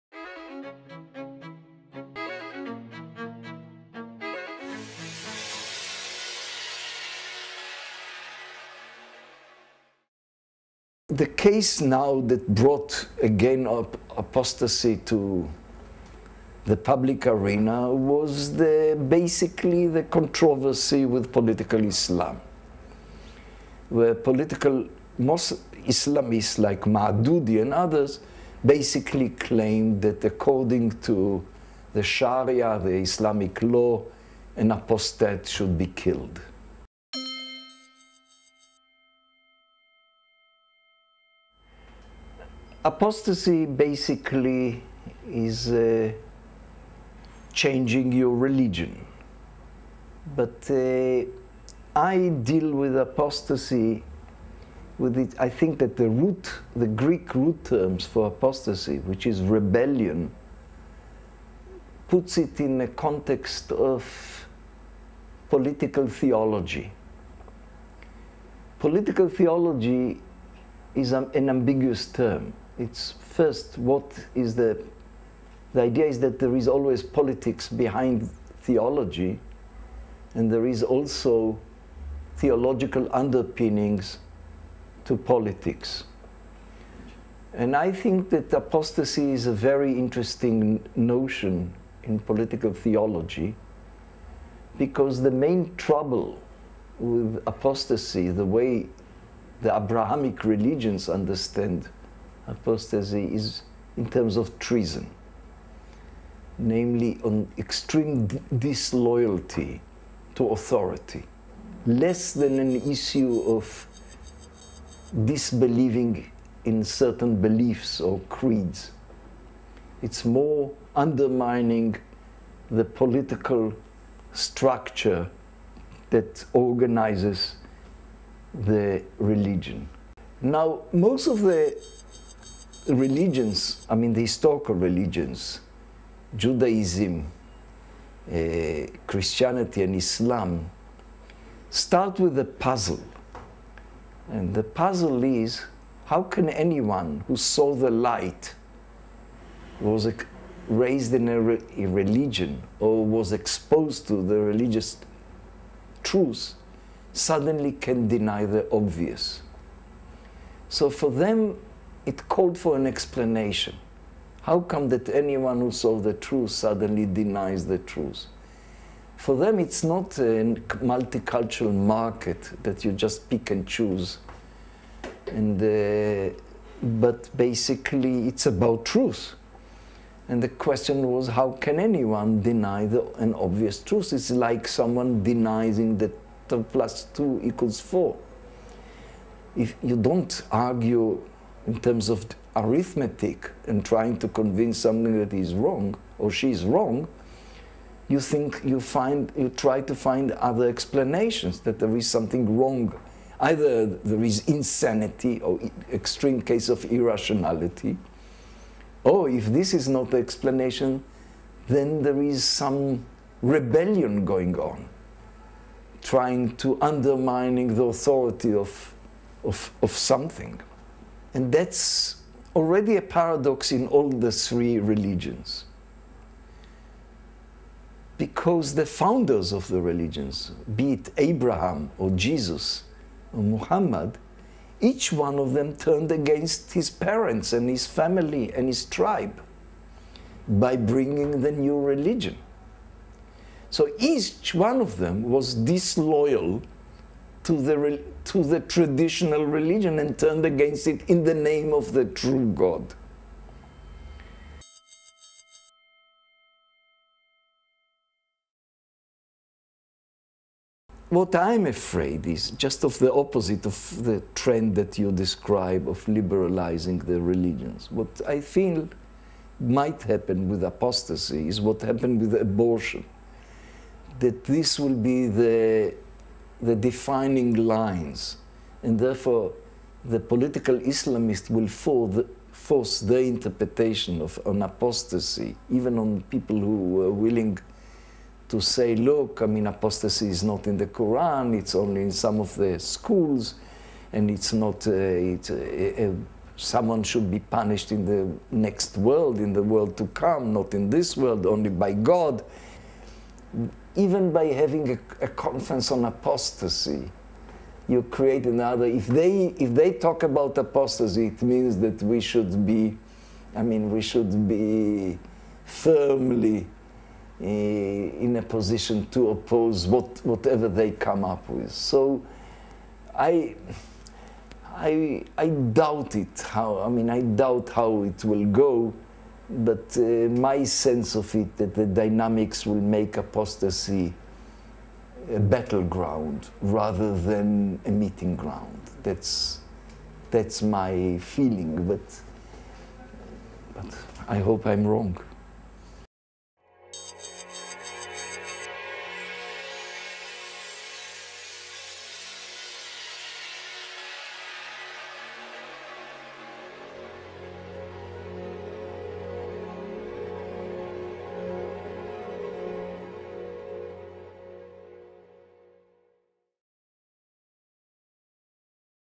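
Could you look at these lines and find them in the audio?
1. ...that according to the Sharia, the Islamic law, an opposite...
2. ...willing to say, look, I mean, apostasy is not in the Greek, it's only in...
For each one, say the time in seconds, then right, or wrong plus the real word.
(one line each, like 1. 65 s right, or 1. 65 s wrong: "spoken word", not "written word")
1. 30 s wrong: "apostate", not "opposite"
2. 287 s wrong: "Quran", not "Greek".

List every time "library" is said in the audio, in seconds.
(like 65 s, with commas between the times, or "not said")
not said.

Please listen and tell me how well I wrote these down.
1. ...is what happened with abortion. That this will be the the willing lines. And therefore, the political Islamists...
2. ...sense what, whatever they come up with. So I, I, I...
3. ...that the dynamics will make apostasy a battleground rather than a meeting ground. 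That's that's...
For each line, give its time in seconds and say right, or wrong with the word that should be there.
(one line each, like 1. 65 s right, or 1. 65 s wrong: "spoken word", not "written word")
1. 271 s wrong: "defining", not "willing"
2. 319 s wrong: "oppose", not "sense"
3. 331 s right.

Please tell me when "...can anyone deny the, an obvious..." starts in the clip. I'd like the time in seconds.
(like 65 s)
181 s.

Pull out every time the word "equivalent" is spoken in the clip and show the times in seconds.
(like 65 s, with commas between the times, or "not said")
not said.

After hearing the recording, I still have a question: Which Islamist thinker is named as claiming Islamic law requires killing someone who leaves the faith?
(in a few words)
Maududi.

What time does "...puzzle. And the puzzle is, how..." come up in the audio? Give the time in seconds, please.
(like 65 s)
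142 s.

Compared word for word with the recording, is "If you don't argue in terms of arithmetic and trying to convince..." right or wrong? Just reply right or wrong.
right.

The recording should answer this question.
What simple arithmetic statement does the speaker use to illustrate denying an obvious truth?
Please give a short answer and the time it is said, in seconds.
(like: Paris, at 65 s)
2 plus 2 equals 4, at 186 s.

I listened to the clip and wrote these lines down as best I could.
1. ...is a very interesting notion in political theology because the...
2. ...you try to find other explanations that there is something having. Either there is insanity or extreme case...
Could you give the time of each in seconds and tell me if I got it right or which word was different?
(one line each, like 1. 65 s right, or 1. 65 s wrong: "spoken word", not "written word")
1. 89 s right
2. 199 s wrong: "wrong", not "having".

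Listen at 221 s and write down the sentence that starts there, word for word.
And that's already a paradox in all the three religions.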